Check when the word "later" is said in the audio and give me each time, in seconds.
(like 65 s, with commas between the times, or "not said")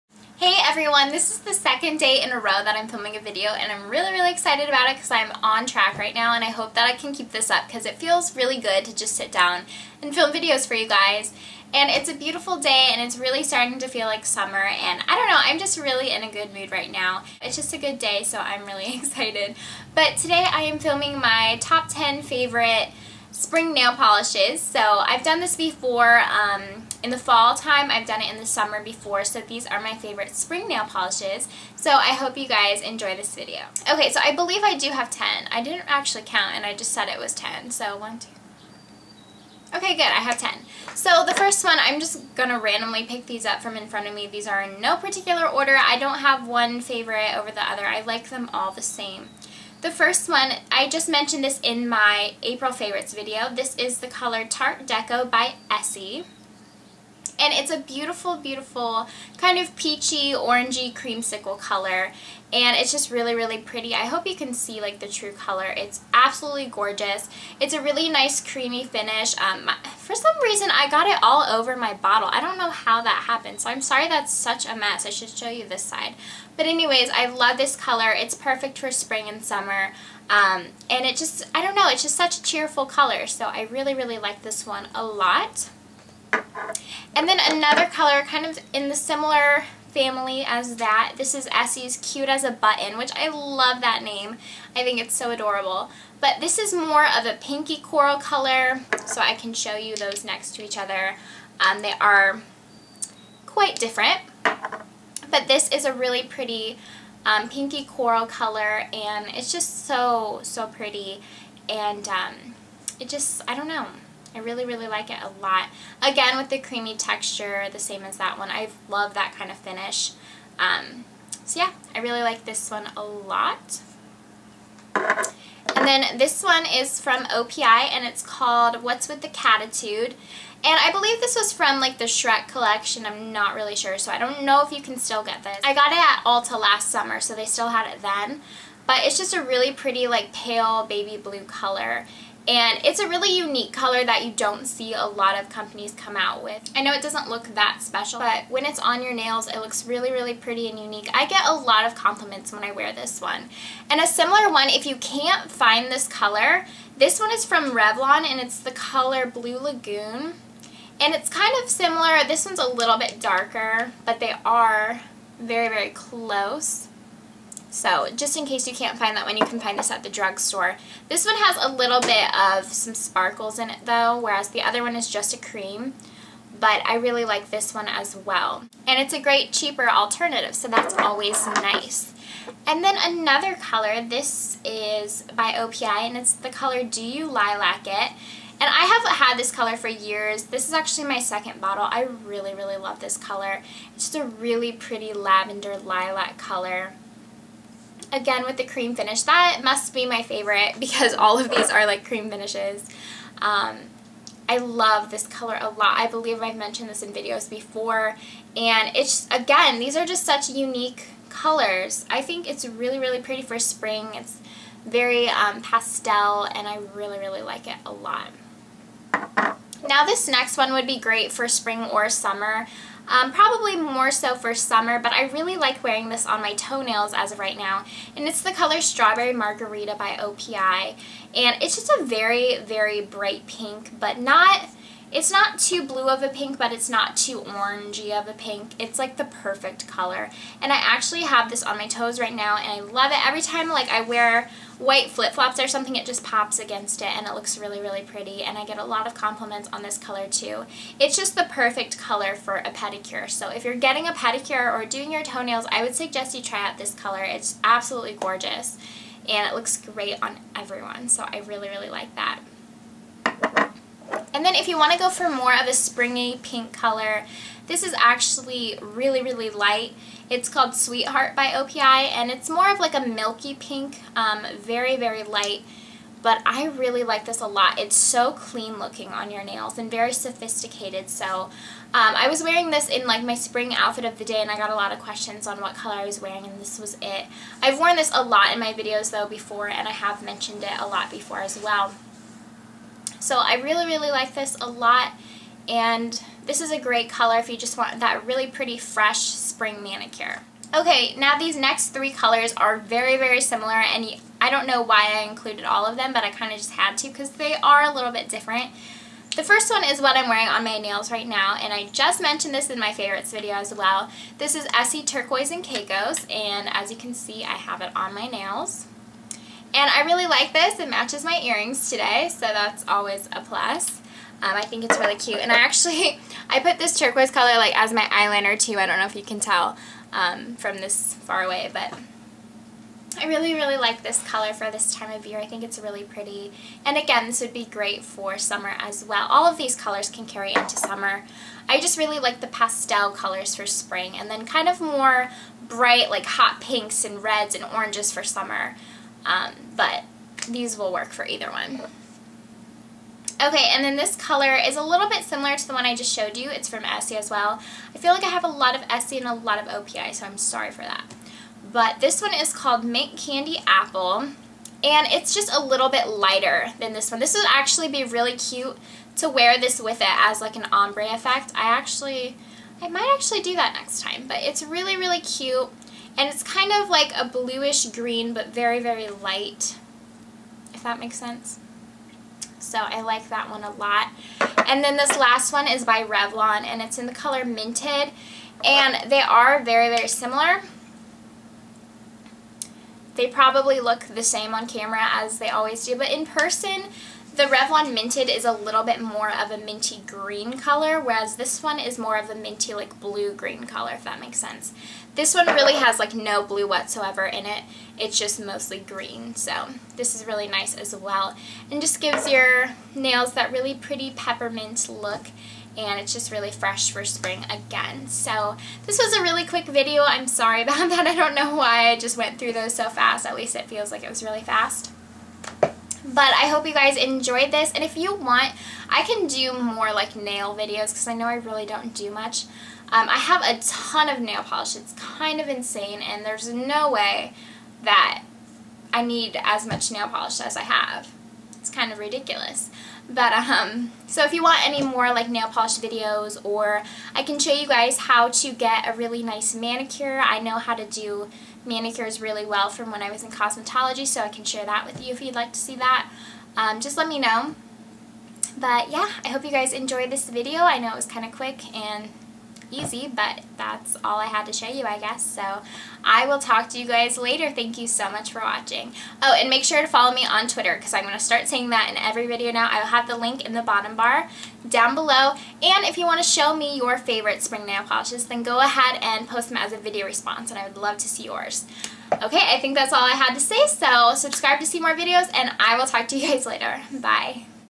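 467 s, 486 s.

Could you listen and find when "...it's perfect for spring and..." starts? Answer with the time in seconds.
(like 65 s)
78 s.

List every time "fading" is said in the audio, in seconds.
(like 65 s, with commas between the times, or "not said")
not said.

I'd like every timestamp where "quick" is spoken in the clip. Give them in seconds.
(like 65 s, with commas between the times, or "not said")
419 s, 461 s.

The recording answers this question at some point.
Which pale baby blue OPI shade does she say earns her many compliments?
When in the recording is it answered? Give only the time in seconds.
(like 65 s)
128 s.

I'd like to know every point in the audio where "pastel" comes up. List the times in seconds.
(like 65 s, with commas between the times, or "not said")
215 s, 342 s.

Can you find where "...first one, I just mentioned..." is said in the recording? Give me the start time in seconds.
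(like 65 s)
49 s.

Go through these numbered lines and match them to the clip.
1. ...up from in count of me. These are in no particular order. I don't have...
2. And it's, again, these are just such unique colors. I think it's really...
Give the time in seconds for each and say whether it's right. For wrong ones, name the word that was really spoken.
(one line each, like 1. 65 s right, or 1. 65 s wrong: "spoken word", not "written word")
1. 43 s wrong: "front", not "count"
2. 208 s right.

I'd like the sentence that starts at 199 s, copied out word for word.
That must be my favorite because all of these are like cream finishes.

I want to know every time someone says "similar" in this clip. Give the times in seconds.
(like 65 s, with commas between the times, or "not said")
88 s, 154 s, 161 s, 303 s, 355 s, 390 s.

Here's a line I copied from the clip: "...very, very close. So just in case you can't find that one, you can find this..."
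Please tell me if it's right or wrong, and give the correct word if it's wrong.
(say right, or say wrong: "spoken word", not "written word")
right.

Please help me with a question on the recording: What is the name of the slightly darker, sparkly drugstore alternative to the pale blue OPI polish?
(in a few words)
Blue Lagoon.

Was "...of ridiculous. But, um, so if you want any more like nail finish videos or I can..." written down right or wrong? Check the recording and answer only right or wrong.
wrong.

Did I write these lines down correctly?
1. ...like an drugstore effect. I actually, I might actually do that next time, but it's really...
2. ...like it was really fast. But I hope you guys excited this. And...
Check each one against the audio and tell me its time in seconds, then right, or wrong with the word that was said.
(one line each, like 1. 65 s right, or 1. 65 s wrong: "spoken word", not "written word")
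1. 370 s wrong: "ombre", not "drugstore"
2. 423 s wrong: "enjoyed", not "excited".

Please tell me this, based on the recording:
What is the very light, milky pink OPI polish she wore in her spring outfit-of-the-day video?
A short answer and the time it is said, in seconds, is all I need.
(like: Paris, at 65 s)
Sweetheart, at 270 s.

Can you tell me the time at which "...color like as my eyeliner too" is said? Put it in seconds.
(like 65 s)
327 s.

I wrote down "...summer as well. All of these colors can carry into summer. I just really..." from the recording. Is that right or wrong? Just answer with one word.
right.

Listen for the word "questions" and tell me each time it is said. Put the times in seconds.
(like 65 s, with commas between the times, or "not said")
284 s.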